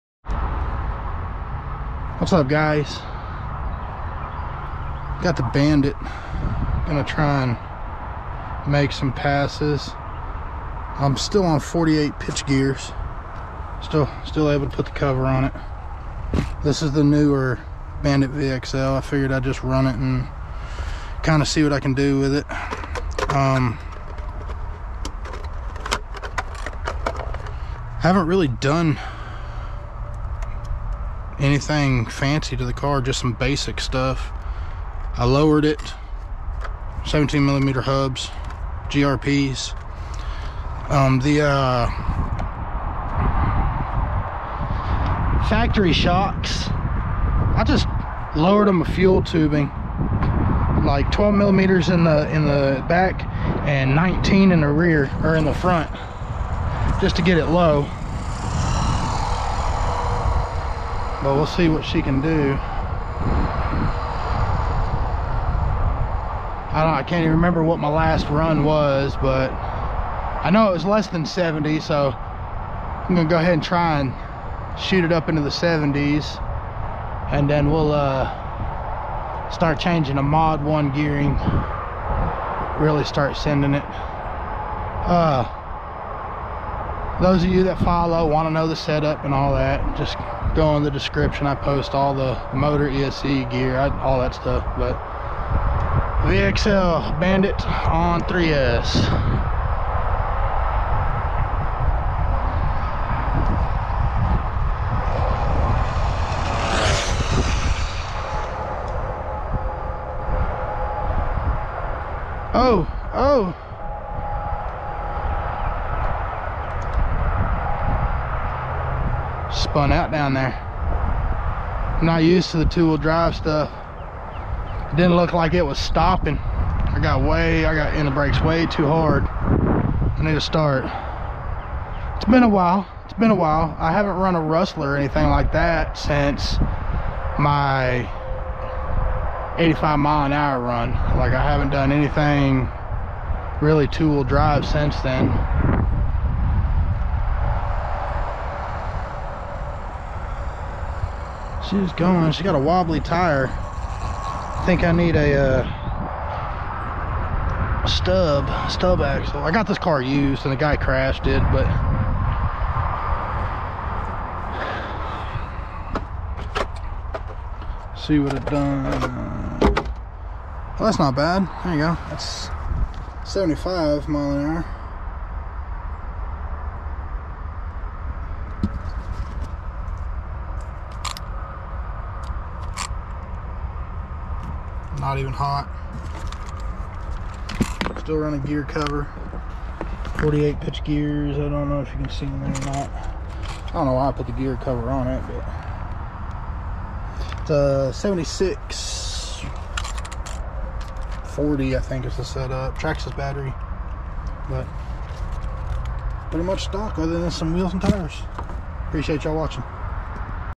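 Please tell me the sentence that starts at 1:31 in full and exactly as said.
I post all the motor ESC gear, I, all that stuff.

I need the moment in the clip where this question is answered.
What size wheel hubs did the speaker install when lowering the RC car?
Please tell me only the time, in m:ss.
0:37.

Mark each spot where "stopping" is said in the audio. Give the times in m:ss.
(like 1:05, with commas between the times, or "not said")
2:05.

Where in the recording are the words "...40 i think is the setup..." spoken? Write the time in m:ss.
3:21.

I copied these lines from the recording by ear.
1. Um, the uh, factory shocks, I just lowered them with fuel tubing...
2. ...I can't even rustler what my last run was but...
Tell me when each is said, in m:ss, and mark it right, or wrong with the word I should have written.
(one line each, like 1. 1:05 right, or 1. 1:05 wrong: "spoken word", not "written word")
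1. 0:40 right
2. 1:06 wrong: "remember", not "rustler".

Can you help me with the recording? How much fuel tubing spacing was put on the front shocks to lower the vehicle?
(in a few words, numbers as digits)
19.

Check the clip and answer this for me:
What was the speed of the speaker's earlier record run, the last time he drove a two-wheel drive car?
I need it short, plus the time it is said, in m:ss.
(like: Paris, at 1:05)
85 mph, at 2:19.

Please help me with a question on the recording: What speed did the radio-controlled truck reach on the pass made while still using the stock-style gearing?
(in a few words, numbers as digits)
75 mph.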